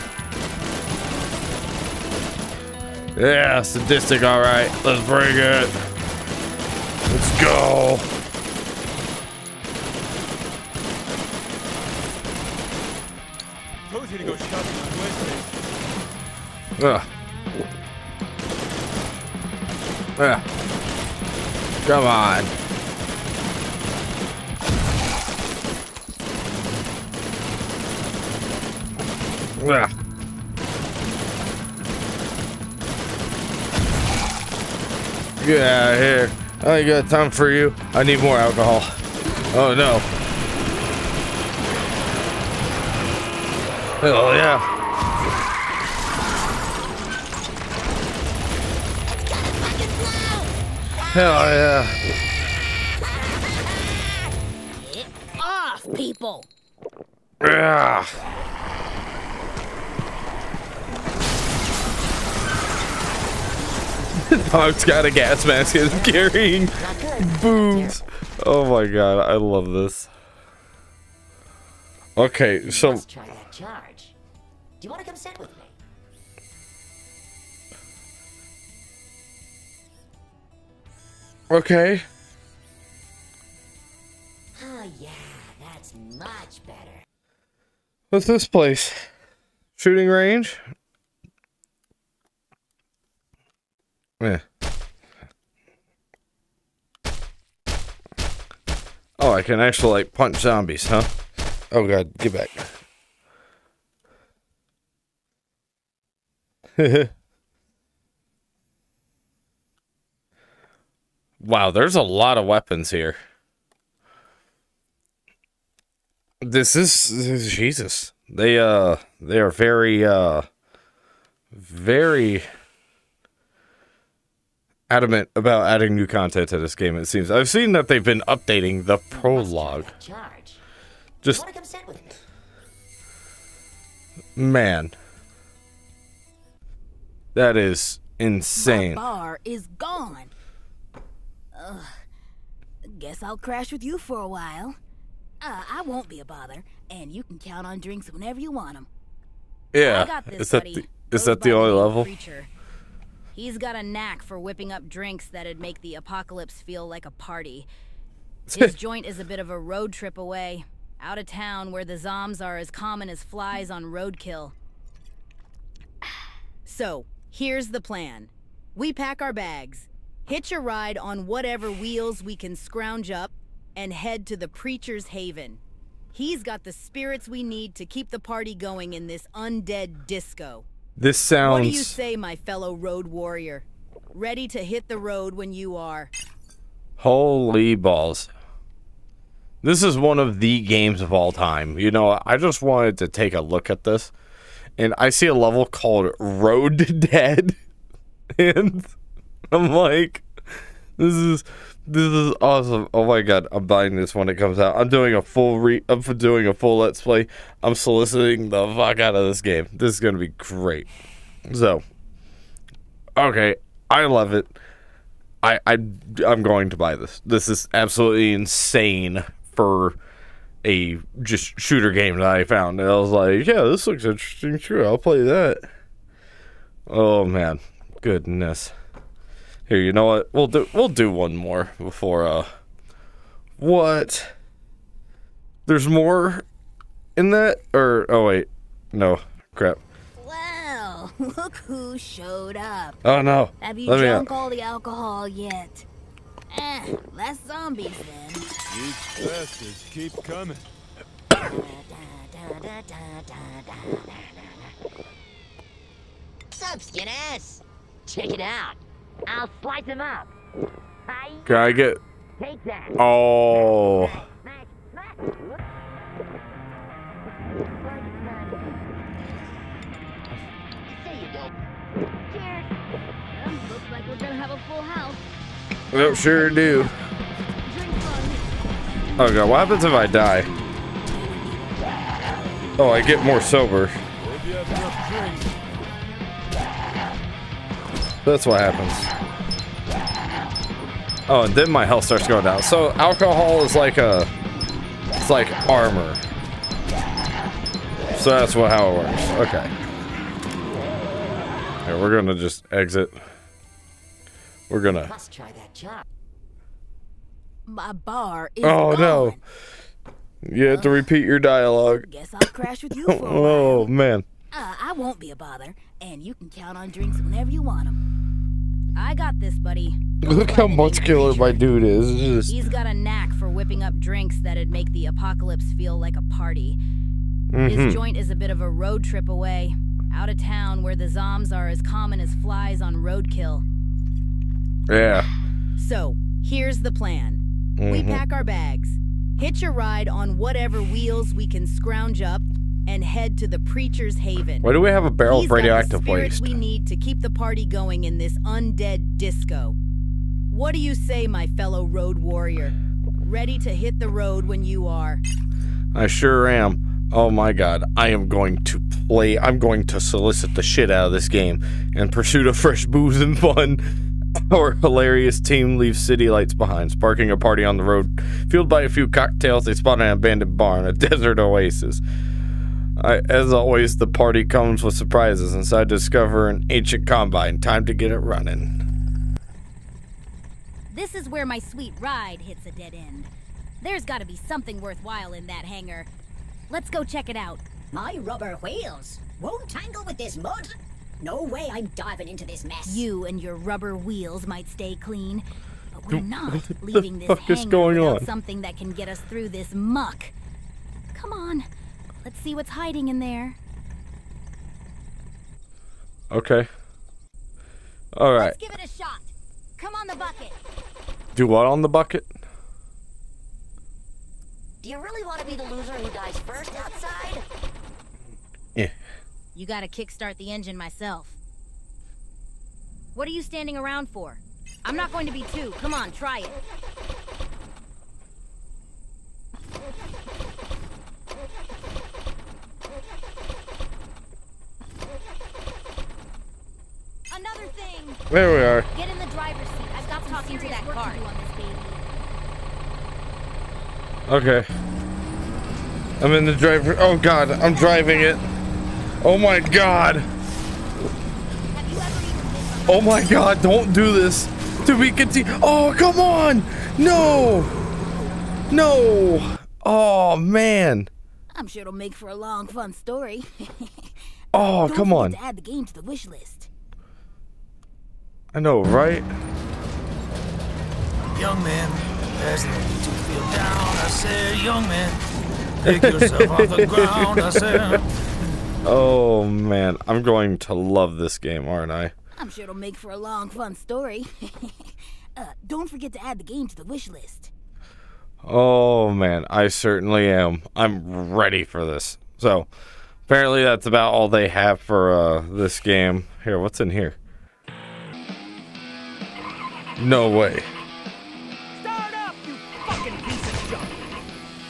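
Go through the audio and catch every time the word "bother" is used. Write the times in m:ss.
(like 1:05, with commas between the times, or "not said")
2:26, 5:15.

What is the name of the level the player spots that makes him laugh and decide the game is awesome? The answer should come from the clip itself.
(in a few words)
Road to Dead.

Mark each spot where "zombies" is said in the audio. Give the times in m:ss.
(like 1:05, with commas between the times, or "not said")
1:40, 4:07.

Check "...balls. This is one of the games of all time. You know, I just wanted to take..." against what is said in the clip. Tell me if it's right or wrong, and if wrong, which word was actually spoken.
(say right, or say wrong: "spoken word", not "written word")
right.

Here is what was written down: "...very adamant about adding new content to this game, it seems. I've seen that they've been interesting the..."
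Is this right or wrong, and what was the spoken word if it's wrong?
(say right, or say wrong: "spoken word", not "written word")
wrong: "updating", not "interesting".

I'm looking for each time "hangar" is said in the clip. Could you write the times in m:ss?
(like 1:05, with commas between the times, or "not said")
6:25, 6:37.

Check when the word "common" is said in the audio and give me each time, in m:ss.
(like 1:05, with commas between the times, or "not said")
2:42, 5:31.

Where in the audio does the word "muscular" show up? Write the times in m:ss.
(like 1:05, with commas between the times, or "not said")
5:20.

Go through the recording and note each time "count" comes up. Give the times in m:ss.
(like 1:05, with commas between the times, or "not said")
2:27, 5:16.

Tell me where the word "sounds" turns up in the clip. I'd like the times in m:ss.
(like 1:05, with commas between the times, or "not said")
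3:01.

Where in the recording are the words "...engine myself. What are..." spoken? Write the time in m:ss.
7:00.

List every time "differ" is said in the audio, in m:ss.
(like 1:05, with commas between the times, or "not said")
not said.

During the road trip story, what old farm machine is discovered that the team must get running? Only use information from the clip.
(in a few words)
Combine.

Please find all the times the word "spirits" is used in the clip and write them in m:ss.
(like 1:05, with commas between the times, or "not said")
2:56.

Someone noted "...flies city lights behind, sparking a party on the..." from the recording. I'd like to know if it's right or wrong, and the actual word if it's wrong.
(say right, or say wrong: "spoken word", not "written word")
wrong: "leaves", not "flies".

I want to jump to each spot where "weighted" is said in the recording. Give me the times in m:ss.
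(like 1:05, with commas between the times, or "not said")
not said.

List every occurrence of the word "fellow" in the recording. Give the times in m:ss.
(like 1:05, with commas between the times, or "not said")
3:02, 5:51.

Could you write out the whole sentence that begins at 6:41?
Come on, Let's see what's hiding in there.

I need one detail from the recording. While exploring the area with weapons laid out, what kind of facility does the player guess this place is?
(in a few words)
Shooting range.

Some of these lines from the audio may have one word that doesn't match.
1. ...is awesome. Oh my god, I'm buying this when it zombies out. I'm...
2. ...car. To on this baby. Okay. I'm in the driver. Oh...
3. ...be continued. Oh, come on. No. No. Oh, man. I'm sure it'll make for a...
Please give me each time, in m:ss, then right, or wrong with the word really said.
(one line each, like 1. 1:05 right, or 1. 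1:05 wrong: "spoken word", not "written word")
1. 3:22 wrong: "comes", not "zombies"
2. 7:20 right
3. 7:34 right.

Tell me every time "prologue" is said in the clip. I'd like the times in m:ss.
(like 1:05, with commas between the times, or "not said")
2:08.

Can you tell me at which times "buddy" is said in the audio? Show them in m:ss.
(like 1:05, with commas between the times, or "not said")
2:30, 5:19.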